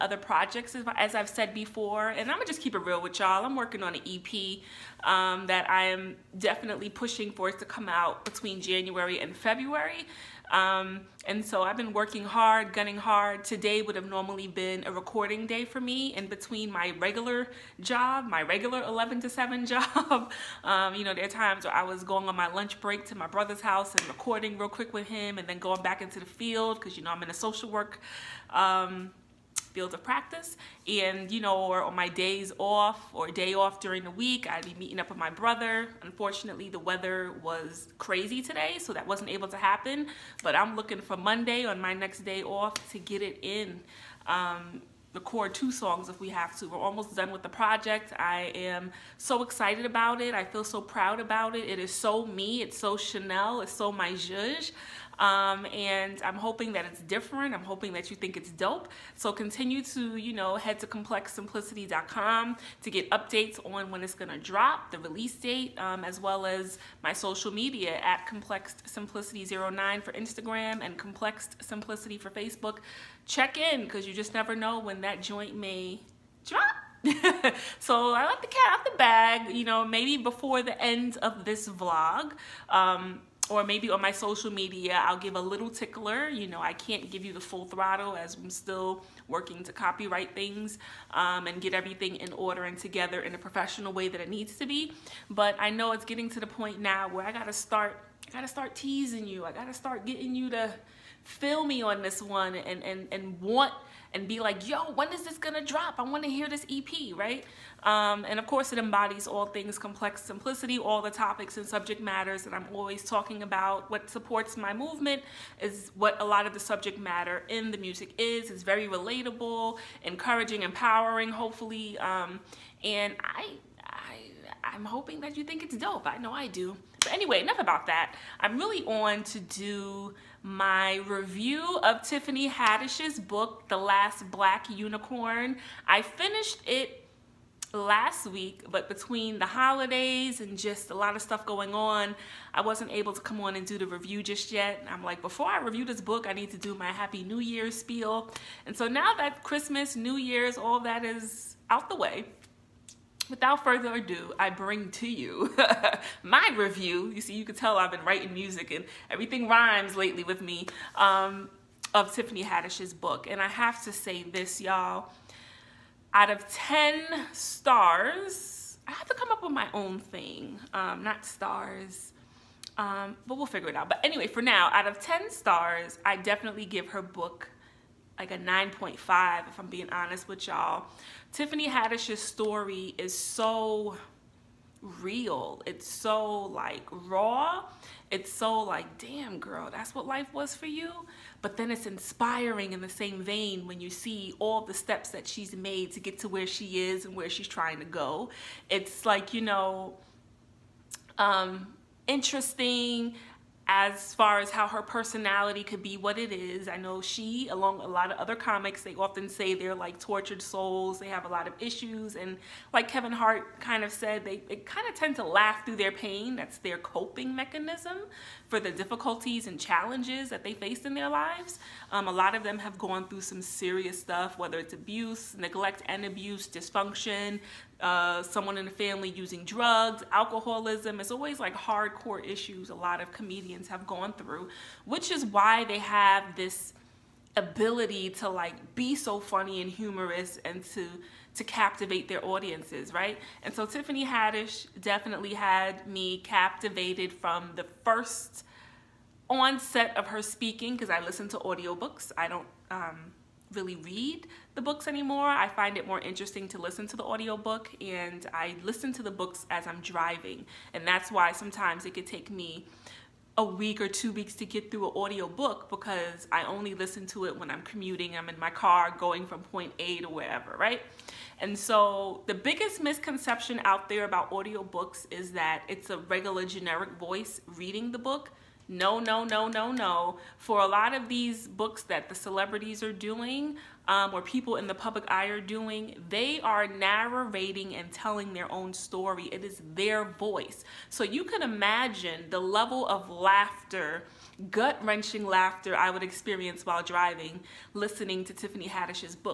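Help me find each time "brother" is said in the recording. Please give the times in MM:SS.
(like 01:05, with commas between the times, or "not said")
00:23, 00:35.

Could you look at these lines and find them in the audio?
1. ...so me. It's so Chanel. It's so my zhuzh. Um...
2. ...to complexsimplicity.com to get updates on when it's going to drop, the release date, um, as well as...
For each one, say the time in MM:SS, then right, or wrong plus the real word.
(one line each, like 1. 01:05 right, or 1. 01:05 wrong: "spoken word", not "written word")
1. 00:51 right
2. 01:00 right.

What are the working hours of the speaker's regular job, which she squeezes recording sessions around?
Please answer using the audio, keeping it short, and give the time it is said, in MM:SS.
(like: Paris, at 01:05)
11 to 7, at 00:18.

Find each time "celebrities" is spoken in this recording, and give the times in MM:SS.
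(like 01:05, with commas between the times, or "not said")
04:42.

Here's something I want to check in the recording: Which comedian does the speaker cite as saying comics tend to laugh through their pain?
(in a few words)
Kevin Hart.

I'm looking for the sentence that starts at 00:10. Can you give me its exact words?
Um, and so I've been working hard, gunning hard.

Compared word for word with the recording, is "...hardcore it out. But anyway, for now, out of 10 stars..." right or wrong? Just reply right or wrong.
wrong.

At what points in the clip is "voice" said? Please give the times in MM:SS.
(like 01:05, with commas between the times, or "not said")
04:36, 04:50.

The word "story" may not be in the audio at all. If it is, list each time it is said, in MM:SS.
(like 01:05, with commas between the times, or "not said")
03:02, 04:48.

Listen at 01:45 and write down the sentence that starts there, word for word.
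I wanna hear this EP, right?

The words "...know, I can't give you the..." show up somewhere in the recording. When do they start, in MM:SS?
01:26.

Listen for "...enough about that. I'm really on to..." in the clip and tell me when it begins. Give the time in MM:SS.
02:07.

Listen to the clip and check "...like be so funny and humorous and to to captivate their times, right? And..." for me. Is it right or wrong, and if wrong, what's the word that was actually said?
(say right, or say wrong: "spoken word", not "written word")
wrong: "audiences", not "times".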